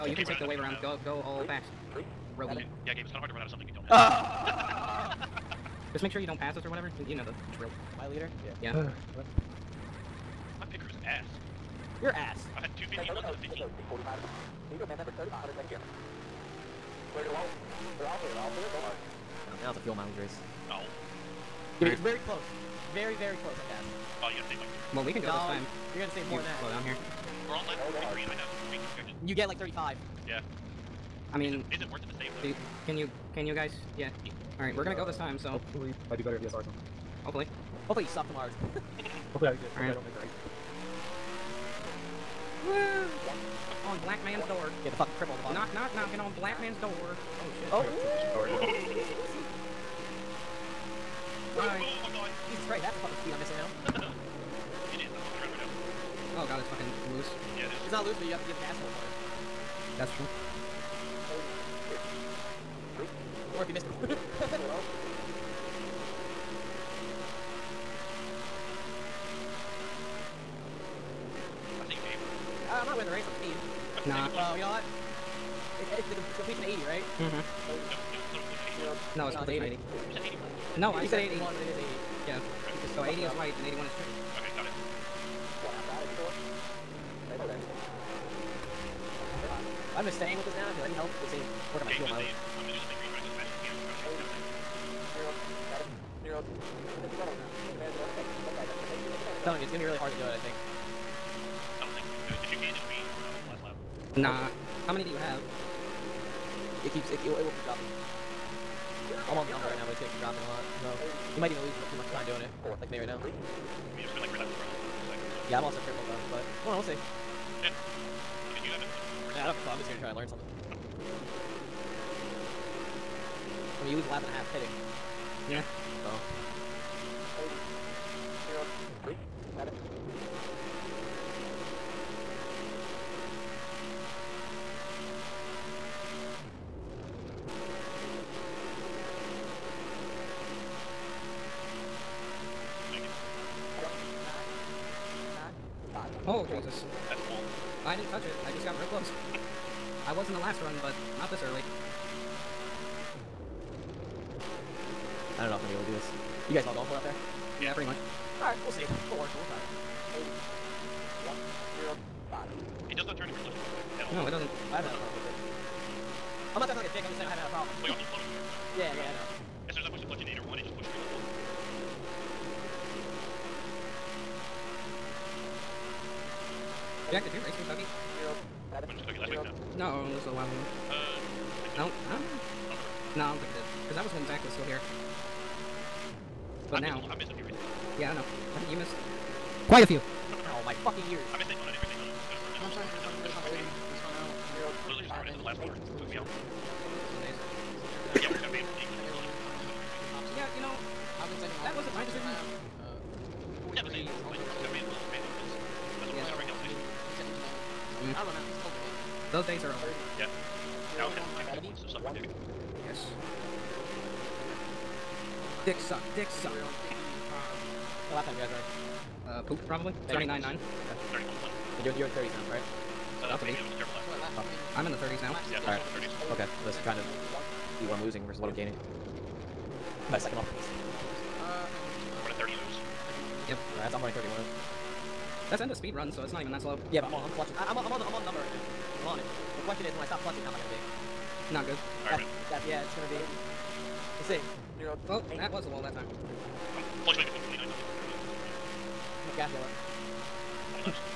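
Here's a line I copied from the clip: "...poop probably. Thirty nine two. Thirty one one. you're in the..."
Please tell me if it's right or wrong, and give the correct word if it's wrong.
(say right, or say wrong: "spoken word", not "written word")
wrong: "nine", not "two".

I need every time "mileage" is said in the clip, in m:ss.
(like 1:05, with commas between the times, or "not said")
0:19, 1:32.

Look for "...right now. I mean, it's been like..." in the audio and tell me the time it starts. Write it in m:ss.
1:52.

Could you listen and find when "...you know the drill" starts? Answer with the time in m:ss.
0:07.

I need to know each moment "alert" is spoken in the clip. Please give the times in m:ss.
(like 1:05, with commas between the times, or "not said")
not said.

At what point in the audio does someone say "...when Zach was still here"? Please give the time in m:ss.
3:04.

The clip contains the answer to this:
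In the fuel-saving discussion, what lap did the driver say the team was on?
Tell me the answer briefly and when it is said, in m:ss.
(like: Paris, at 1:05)
43, at 0:27.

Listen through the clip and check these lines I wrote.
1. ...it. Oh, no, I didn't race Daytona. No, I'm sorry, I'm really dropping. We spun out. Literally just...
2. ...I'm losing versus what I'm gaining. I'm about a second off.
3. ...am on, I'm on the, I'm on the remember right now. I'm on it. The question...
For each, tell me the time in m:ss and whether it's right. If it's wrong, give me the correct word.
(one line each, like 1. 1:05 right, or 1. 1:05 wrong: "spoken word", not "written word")
1. 3:11 wrong: "concentrating", not "dropping"
2. 3:47 right
3. 3:57 wrong: "number", not "remember".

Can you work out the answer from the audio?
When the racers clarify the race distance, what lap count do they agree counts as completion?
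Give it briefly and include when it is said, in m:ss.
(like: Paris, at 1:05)
80, at 1:19.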